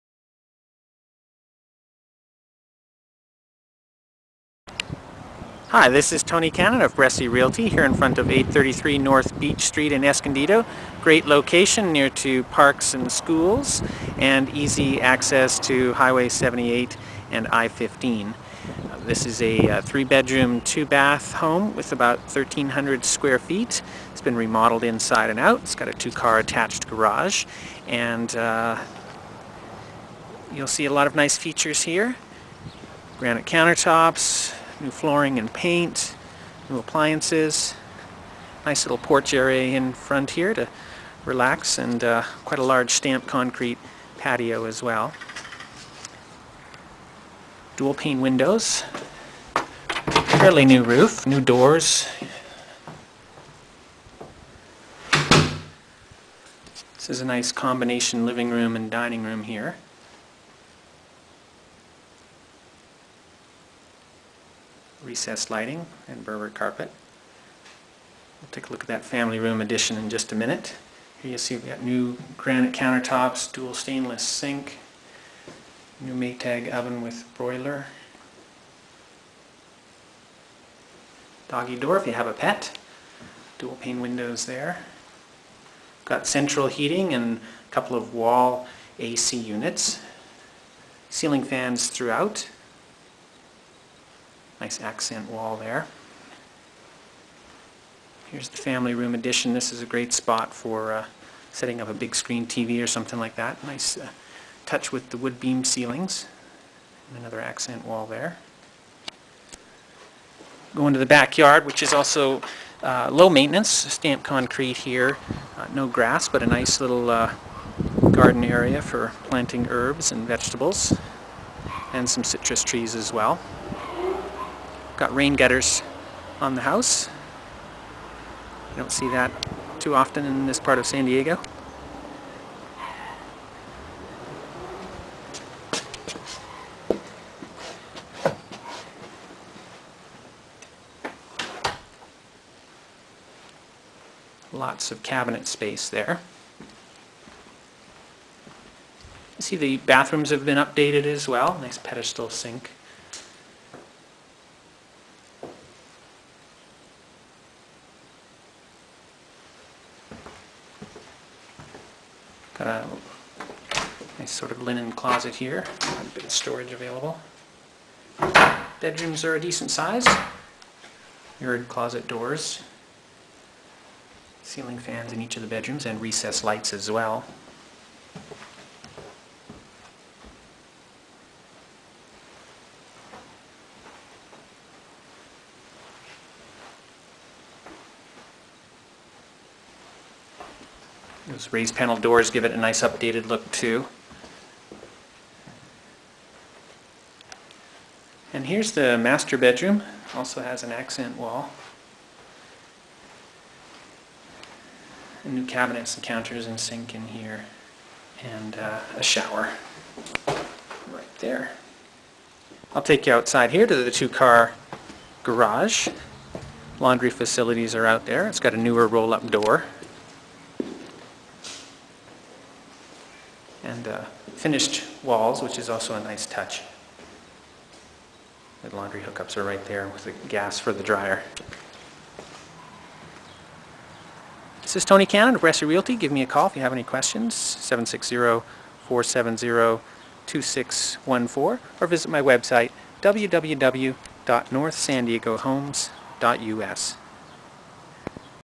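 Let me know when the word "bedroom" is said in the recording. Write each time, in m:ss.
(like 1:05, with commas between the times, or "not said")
0:19, 2:48, 2:55, 3:19.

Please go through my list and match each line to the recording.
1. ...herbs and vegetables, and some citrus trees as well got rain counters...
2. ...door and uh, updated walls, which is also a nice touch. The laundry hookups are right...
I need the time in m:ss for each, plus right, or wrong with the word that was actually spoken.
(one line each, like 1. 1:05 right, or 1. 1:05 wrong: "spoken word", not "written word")
1. 1:59 wrong: "gutters", not "counters"
2. 3:39 wrong: "finished", not "updated".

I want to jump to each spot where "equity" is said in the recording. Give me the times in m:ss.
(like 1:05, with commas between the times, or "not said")
not said.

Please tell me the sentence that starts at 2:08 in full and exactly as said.
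You don't see that too often in this part of San Diego.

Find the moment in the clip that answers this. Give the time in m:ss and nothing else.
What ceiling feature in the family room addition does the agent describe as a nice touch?
1:45.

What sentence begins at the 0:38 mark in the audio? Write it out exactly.
Nice little porch area in front here to relax and uh, quite a large stamped concrete patio as well.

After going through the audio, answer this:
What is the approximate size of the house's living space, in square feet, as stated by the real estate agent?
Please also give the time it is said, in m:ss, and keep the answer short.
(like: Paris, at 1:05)
1,300, at 0:22.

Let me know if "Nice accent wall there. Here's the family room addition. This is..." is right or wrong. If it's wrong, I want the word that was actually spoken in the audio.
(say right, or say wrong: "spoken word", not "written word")
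right.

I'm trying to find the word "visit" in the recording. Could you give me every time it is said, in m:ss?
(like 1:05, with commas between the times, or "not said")
4:01.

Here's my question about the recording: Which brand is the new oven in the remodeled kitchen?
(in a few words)
Maytag.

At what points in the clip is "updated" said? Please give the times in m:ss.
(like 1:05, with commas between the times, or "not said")
2:30, 3:12.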